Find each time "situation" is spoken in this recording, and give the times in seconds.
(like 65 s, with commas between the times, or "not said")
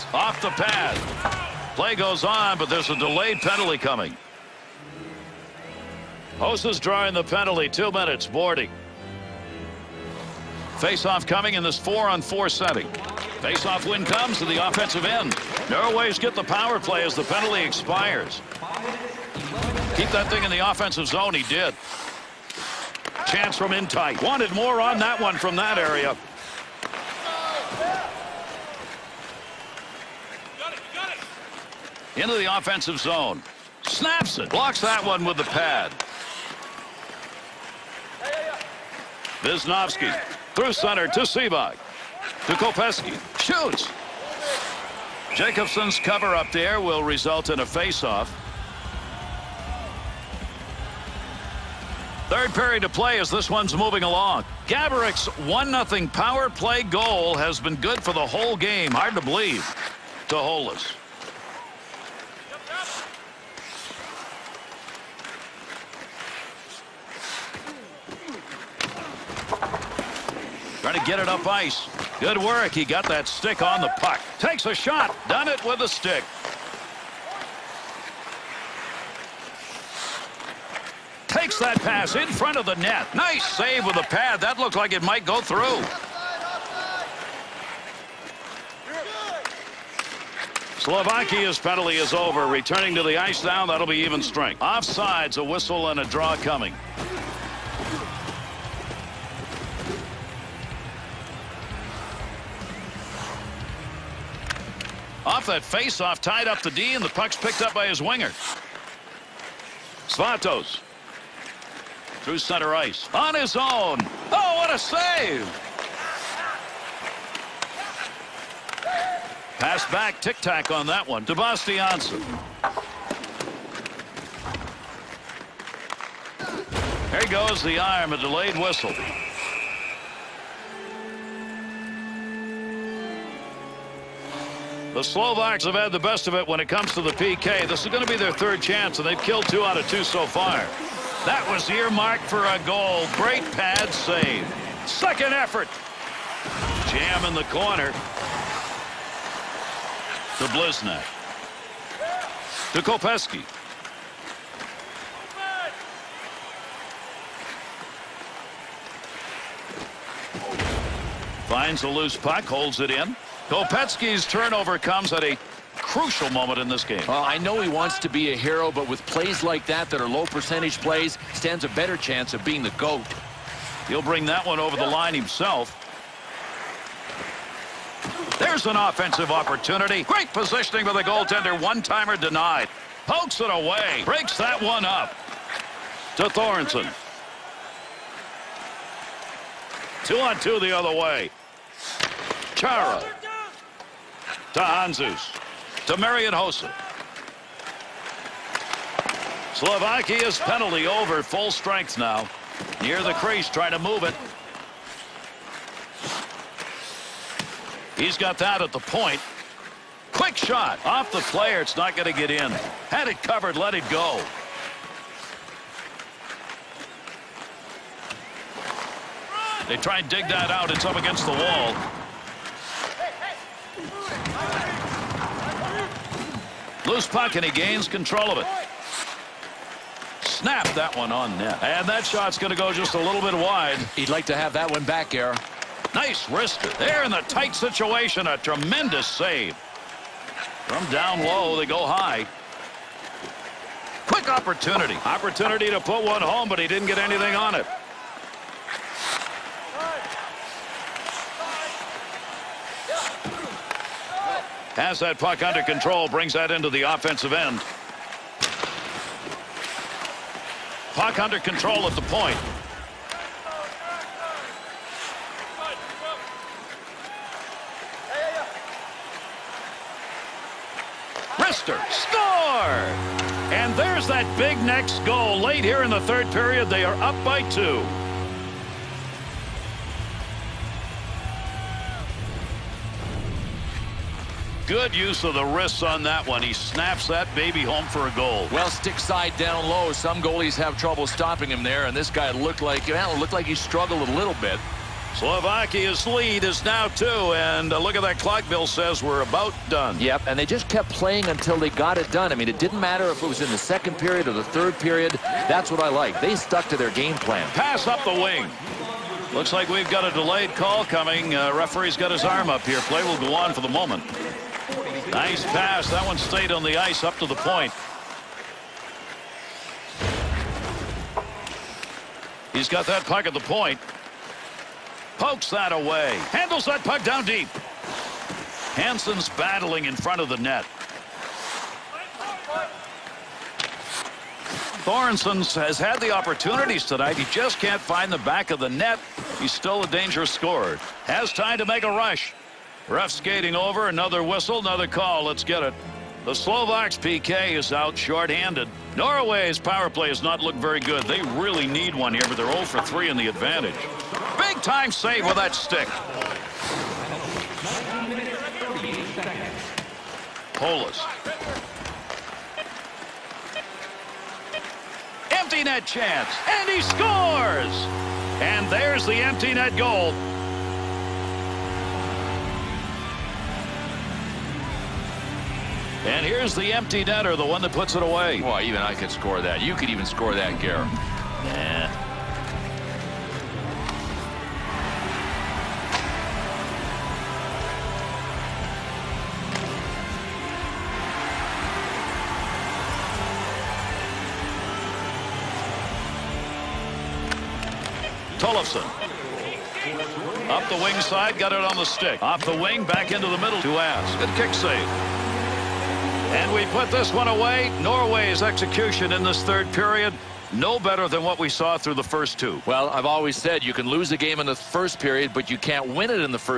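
237 s.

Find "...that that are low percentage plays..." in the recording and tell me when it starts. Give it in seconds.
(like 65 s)
169 s.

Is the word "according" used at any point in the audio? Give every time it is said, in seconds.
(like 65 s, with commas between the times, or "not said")
not said.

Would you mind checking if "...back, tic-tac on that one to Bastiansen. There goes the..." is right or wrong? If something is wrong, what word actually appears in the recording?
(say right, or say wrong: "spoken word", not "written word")
right.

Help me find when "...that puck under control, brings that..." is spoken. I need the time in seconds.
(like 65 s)
254 s.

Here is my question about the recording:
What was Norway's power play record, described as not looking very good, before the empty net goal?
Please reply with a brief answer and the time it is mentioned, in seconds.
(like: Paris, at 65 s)
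0 for 3, at 352 s.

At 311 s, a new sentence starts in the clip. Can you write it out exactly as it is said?
Uh, referee's got his arm up here.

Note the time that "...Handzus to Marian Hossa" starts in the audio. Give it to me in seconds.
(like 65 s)
194 s.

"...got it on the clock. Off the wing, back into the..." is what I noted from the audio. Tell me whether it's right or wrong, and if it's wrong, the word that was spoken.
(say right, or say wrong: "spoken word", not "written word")
wrong: "stick", not "clock".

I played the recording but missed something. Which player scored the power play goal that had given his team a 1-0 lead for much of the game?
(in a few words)
Gaborik.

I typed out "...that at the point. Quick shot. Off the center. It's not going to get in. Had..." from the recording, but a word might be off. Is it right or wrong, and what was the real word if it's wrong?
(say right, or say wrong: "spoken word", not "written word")
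wrong: "player", not "center".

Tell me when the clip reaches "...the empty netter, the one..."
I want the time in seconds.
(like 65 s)
376 s.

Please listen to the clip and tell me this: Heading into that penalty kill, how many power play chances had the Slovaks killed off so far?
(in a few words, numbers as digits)
2.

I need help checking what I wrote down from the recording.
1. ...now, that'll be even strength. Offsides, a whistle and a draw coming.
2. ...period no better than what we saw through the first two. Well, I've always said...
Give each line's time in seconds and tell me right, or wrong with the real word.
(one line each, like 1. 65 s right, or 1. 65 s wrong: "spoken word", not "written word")
1. 93 s right
2. 409 s right.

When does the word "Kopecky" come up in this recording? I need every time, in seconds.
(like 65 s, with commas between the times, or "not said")
42 s, 152 s, 163 s.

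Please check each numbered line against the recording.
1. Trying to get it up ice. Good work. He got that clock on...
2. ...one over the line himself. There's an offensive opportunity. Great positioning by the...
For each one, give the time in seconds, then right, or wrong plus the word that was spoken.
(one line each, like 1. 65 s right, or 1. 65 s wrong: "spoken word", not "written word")
1. 70 s wrong: "stick", not "clock"
2. 174 s right.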